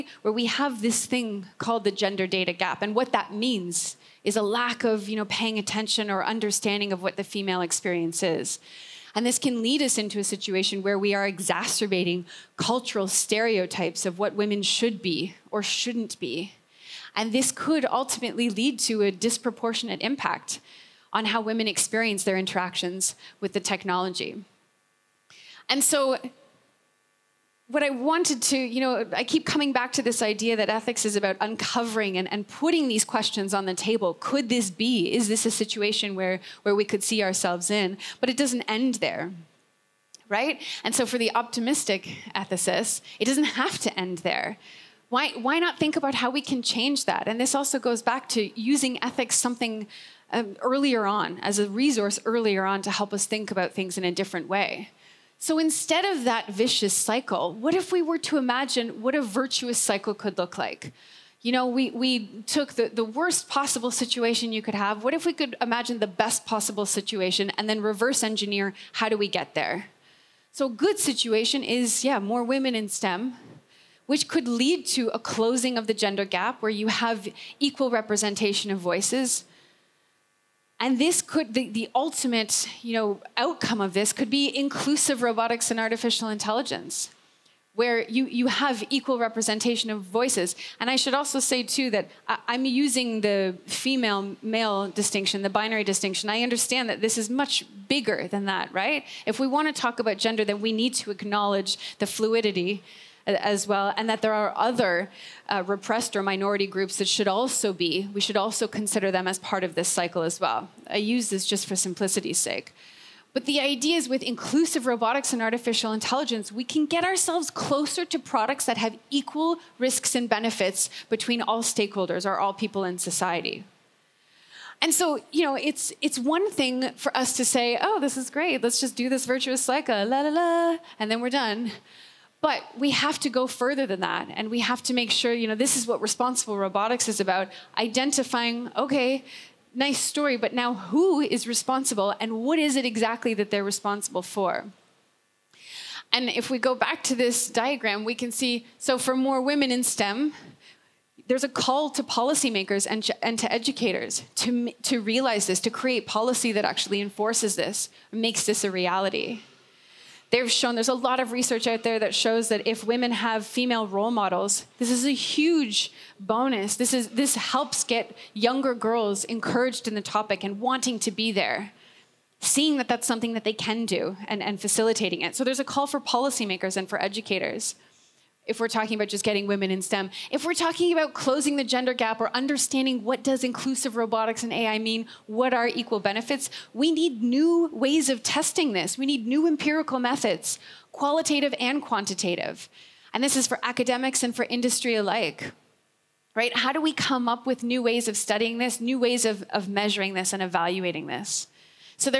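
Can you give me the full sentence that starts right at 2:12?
But we have to go further than that.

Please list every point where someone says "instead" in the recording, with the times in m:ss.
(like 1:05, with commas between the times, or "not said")
0:55.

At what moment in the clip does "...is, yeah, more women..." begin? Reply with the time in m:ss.
1:11.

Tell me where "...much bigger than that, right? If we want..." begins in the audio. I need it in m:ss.
1:37.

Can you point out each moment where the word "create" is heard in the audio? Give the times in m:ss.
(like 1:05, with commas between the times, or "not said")
2:35.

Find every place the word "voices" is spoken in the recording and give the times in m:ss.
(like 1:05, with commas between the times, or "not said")
1:18, 1:30.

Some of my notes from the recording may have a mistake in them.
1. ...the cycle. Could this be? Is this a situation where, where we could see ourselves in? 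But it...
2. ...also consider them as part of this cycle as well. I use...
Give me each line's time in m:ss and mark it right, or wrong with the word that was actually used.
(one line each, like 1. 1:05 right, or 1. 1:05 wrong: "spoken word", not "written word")
1. 0:33 wrong: "table", not "cycle"
2. 1:48 right.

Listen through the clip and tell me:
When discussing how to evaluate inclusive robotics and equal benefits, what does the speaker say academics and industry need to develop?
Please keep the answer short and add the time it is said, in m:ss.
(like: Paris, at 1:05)
new empirical methods, at 3:09.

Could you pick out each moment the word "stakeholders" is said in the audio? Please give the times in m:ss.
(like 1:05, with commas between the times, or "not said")
2:01.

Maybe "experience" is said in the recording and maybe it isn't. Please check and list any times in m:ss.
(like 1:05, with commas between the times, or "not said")
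0:07, 0:21.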